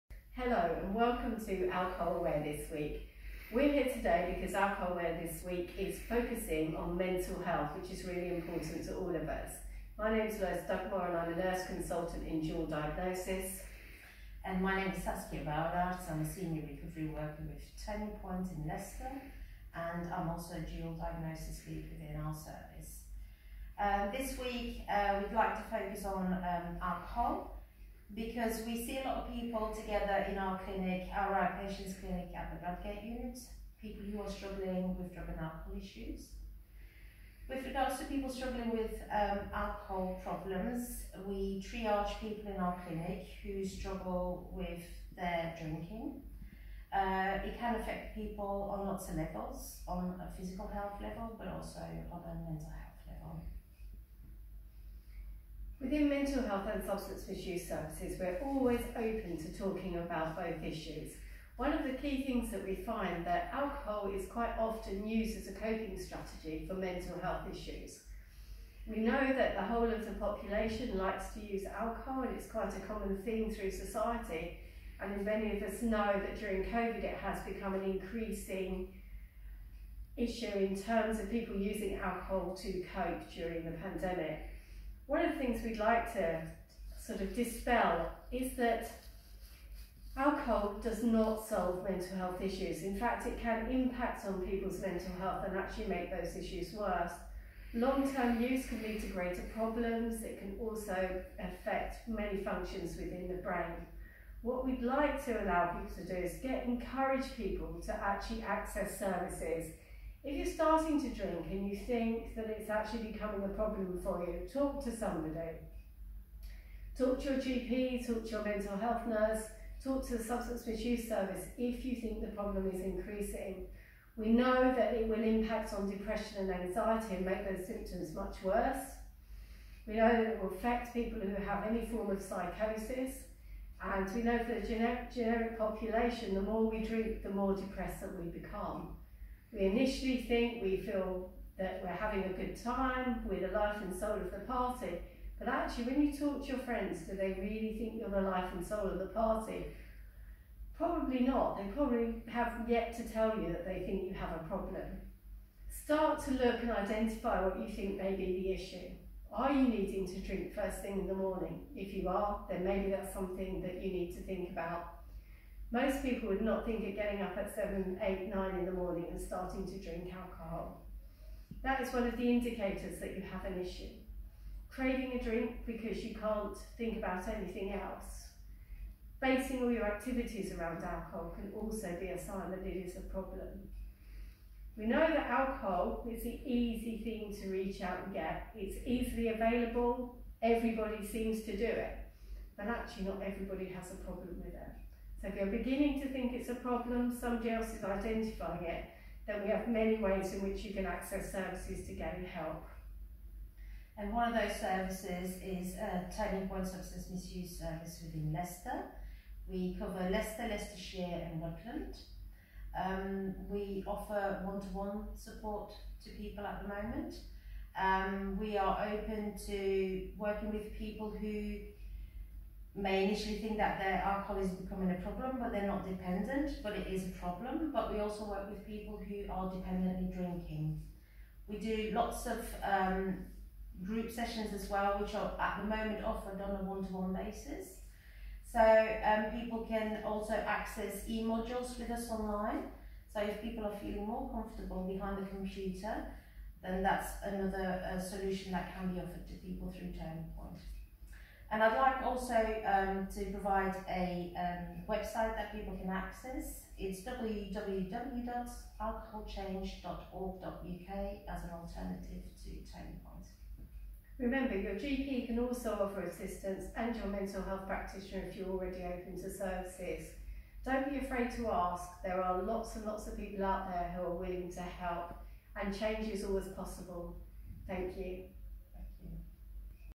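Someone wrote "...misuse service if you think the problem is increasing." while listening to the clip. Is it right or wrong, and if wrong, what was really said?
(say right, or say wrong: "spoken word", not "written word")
right.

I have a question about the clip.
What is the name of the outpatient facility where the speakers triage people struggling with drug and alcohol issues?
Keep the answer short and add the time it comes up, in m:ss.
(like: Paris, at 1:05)
Bradgate unit, at 0:32.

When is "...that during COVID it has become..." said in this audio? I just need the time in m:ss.
1:16.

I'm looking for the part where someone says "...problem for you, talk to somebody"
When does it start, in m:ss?
1:53.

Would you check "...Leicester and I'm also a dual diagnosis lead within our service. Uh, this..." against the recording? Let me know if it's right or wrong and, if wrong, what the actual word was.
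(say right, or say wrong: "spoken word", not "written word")
right.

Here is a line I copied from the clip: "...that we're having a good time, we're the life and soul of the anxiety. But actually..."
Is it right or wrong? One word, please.
wrong.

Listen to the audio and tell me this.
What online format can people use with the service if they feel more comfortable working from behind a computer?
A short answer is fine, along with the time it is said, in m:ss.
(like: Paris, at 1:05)
e-modules, at 4:01.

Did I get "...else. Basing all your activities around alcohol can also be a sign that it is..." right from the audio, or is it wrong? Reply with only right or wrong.
right.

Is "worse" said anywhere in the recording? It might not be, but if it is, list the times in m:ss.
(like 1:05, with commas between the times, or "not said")
1:36, 2:08.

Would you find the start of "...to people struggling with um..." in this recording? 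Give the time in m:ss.
0:37.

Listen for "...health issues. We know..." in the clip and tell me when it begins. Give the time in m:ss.
1:07.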